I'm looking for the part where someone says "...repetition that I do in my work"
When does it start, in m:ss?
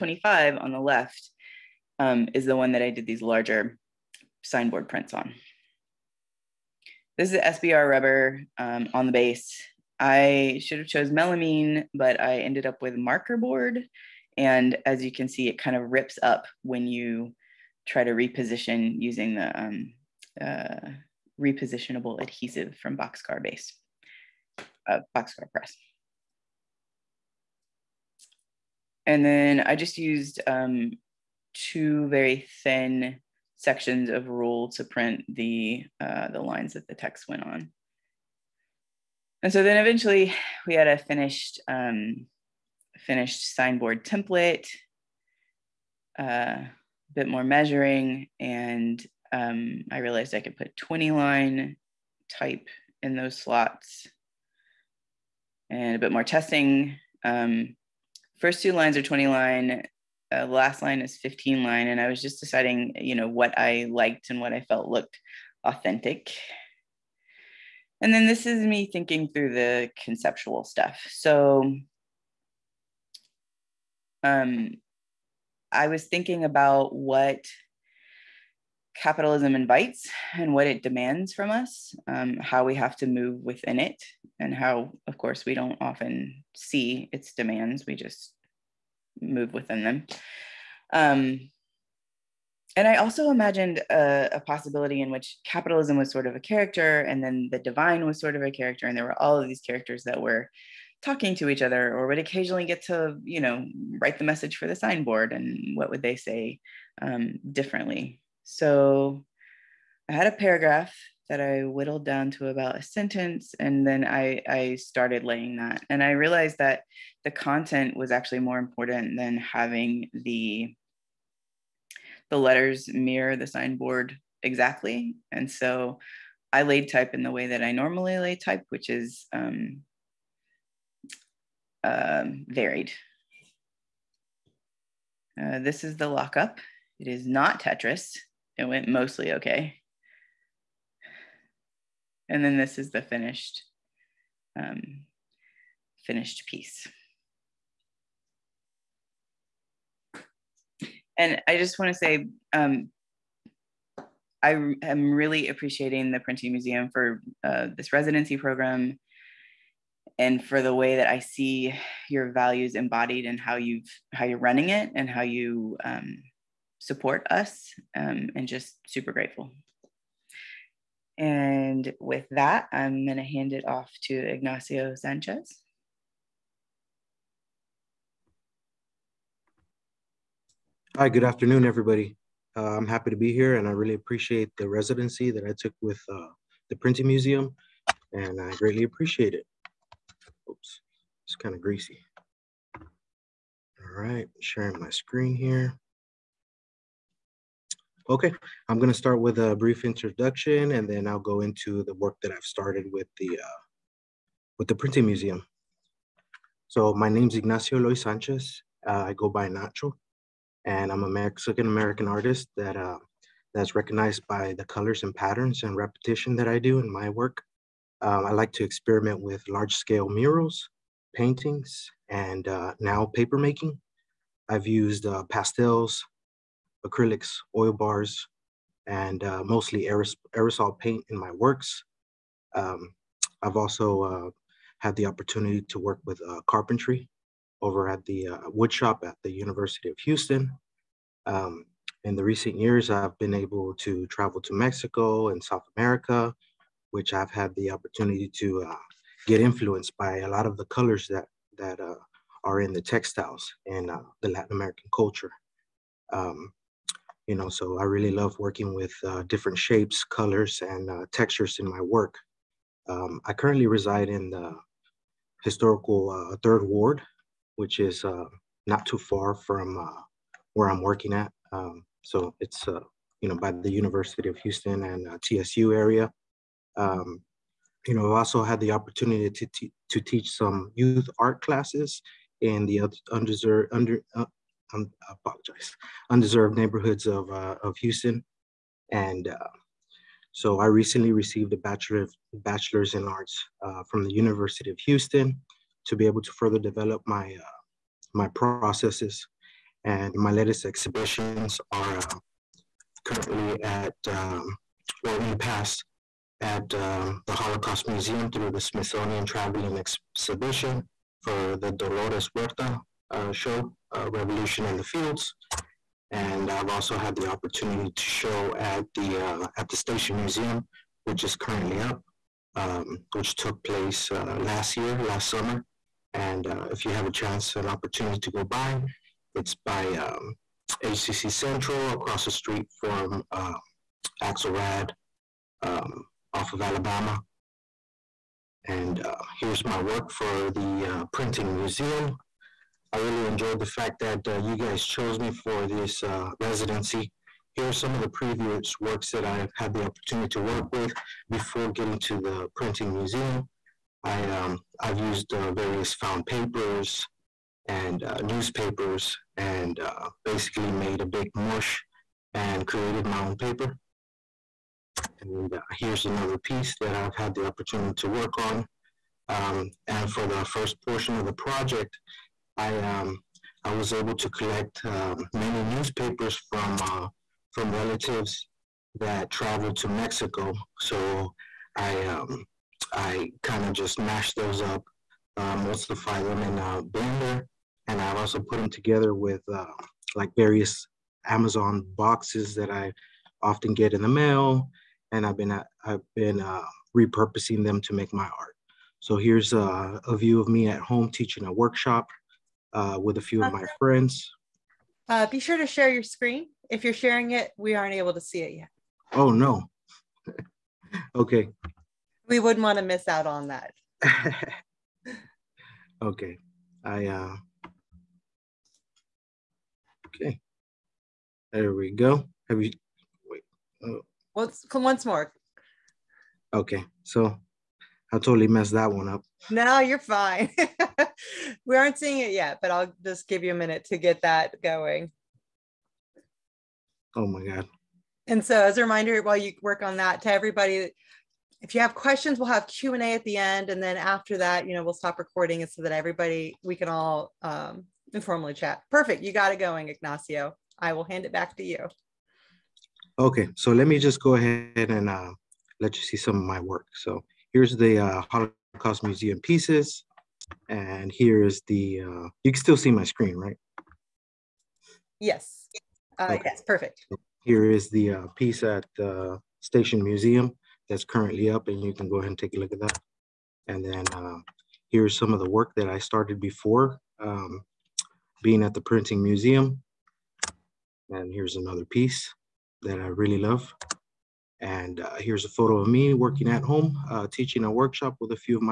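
3:35.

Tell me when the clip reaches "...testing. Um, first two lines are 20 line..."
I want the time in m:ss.
0:56.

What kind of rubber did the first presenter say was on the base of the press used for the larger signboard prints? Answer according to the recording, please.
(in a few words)
SBR rubber.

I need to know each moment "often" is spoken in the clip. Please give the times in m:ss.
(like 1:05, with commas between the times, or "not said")
1:25, 6:33.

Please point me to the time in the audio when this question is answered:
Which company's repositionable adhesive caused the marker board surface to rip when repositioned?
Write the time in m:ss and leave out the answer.
0:25.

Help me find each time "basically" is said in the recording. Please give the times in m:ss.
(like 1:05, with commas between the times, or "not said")
6:00.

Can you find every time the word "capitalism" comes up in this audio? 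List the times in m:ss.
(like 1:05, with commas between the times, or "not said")
1:19, 1:35.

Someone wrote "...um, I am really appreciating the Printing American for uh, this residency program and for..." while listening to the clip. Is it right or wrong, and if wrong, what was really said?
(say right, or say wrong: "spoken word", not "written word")
wrong: "Museum", not "American".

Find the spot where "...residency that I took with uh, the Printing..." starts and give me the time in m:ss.
3:04.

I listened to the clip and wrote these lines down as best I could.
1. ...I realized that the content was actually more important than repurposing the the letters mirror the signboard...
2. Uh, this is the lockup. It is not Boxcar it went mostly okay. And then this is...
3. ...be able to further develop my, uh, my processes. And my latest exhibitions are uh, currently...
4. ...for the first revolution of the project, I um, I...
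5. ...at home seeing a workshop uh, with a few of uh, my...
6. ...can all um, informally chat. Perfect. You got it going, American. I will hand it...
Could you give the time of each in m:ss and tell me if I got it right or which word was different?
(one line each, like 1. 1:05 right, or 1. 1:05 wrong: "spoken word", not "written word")
1. 1:56 wrong: "having", not "repurposing"
2. 2:15 wrong: "Tetris", not "Boxcar"
3. 4:55 right
4. 6:10 wrong: "portion", not "revolution"
5. 6:40 wrong: "teaching", not "seeing"
6. 7:26 wrong: "Ignacio", not "American".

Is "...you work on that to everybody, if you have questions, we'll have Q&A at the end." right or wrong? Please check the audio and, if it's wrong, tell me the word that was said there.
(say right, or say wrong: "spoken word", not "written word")
right.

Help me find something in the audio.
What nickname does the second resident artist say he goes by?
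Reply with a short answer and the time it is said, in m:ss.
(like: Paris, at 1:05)
Nacho, at 3:29.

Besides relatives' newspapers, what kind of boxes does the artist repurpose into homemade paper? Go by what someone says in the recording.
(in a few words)
Amazon boxes.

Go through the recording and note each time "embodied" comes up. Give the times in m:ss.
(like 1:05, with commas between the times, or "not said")
2:42.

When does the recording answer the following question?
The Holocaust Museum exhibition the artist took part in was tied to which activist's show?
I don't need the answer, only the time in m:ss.
5:11.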